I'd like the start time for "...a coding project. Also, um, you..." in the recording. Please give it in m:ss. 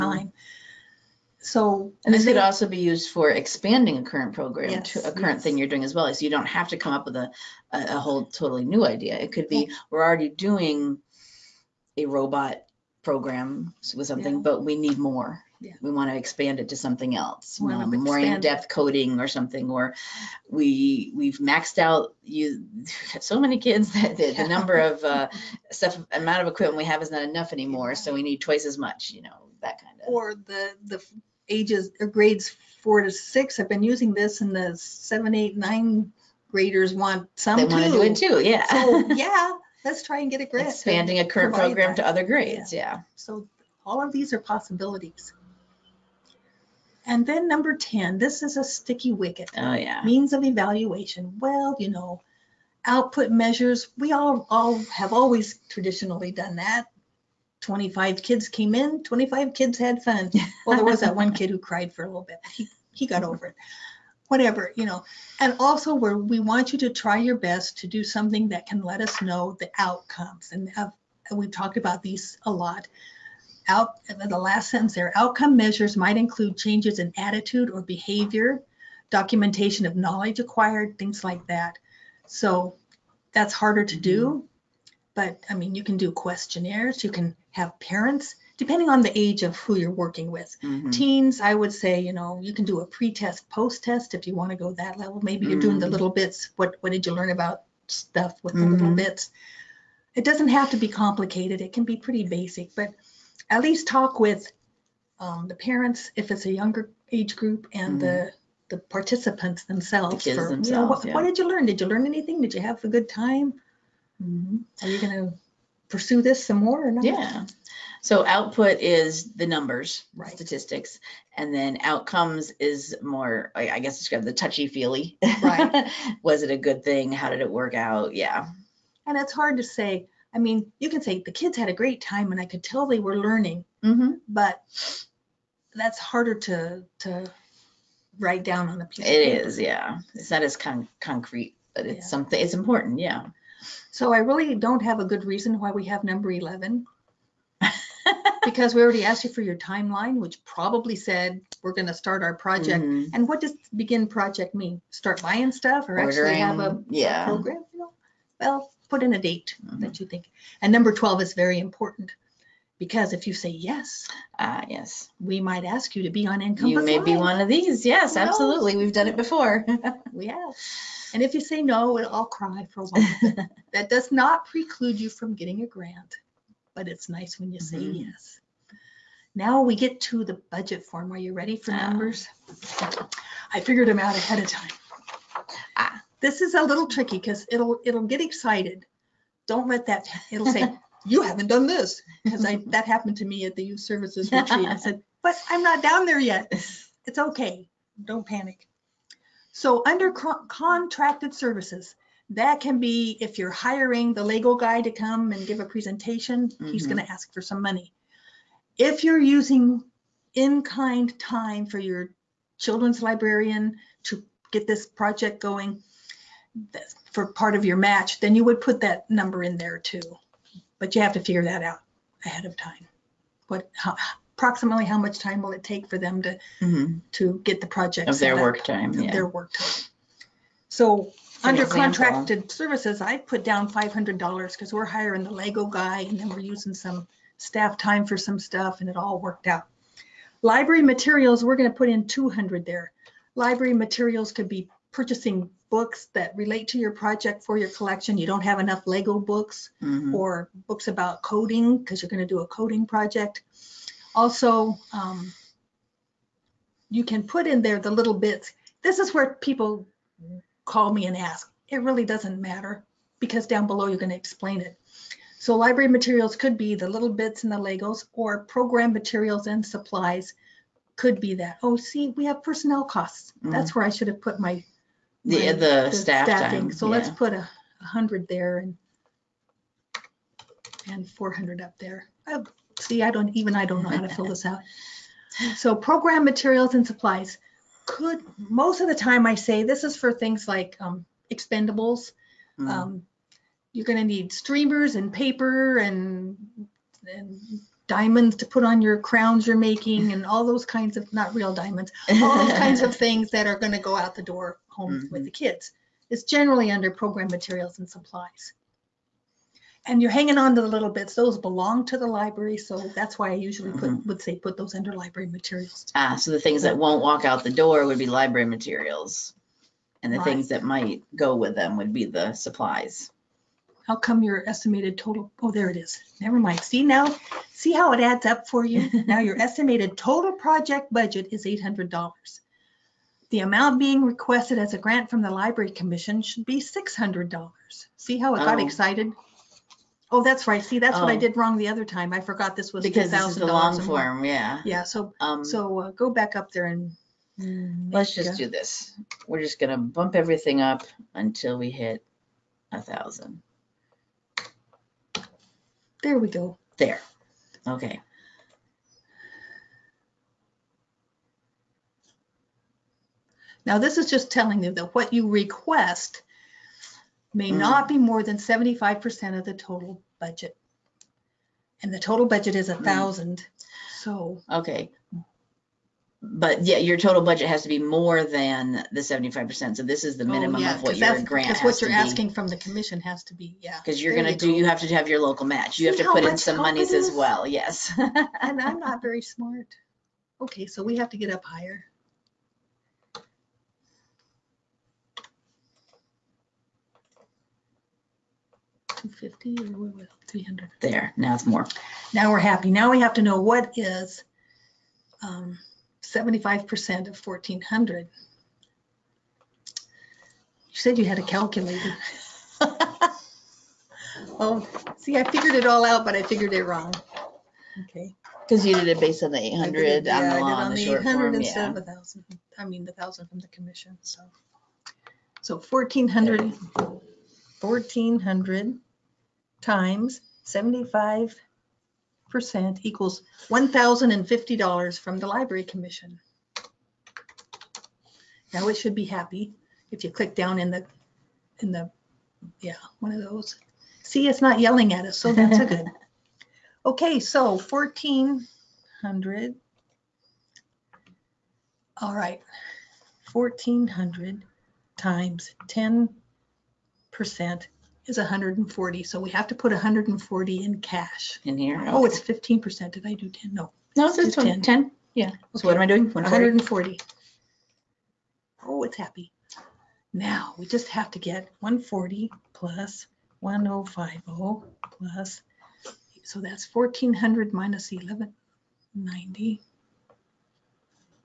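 4:12.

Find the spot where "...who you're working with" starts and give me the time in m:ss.
1:29.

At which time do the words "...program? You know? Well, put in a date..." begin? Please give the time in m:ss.
2:37.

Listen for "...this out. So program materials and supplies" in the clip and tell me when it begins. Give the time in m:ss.
4:44.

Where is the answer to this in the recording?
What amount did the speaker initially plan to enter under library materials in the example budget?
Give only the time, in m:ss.
4:02.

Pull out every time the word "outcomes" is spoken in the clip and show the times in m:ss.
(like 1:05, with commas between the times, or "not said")
1:09, 1:15, 2:01.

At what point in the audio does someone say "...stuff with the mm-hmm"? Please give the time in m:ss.
1:37.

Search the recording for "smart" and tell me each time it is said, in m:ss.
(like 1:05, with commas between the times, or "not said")
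6:29.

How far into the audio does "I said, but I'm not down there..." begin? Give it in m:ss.
3:14.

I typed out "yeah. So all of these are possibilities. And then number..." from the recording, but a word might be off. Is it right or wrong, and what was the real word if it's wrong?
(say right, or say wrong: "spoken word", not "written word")
right.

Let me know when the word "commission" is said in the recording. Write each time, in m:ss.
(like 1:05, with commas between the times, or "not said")
5:35, 6:22, 7:03, 7:15.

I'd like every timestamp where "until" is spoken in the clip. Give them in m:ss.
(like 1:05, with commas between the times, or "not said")
5:51.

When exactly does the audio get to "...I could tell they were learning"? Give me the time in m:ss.
2:12.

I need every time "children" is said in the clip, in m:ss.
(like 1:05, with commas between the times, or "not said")
3:32.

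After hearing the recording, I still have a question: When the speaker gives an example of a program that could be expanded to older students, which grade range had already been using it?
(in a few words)
grades 4 to 6.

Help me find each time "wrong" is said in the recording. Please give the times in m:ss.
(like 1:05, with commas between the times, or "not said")
5:41, 6:56.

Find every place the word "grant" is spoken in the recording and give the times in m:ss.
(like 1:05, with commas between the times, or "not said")
0:40, 2:55, 5:34, 6:21.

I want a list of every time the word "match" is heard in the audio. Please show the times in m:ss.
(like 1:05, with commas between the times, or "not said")
3:37, 6:25.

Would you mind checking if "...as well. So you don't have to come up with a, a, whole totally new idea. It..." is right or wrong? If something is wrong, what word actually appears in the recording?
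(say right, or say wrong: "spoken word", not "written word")
right.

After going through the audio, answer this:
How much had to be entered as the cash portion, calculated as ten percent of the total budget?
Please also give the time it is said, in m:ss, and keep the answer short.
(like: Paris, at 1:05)
140, at 7:39.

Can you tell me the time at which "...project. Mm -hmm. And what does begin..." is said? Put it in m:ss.
2:32.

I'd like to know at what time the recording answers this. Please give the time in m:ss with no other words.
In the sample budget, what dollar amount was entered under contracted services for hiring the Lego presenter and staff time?
3:53.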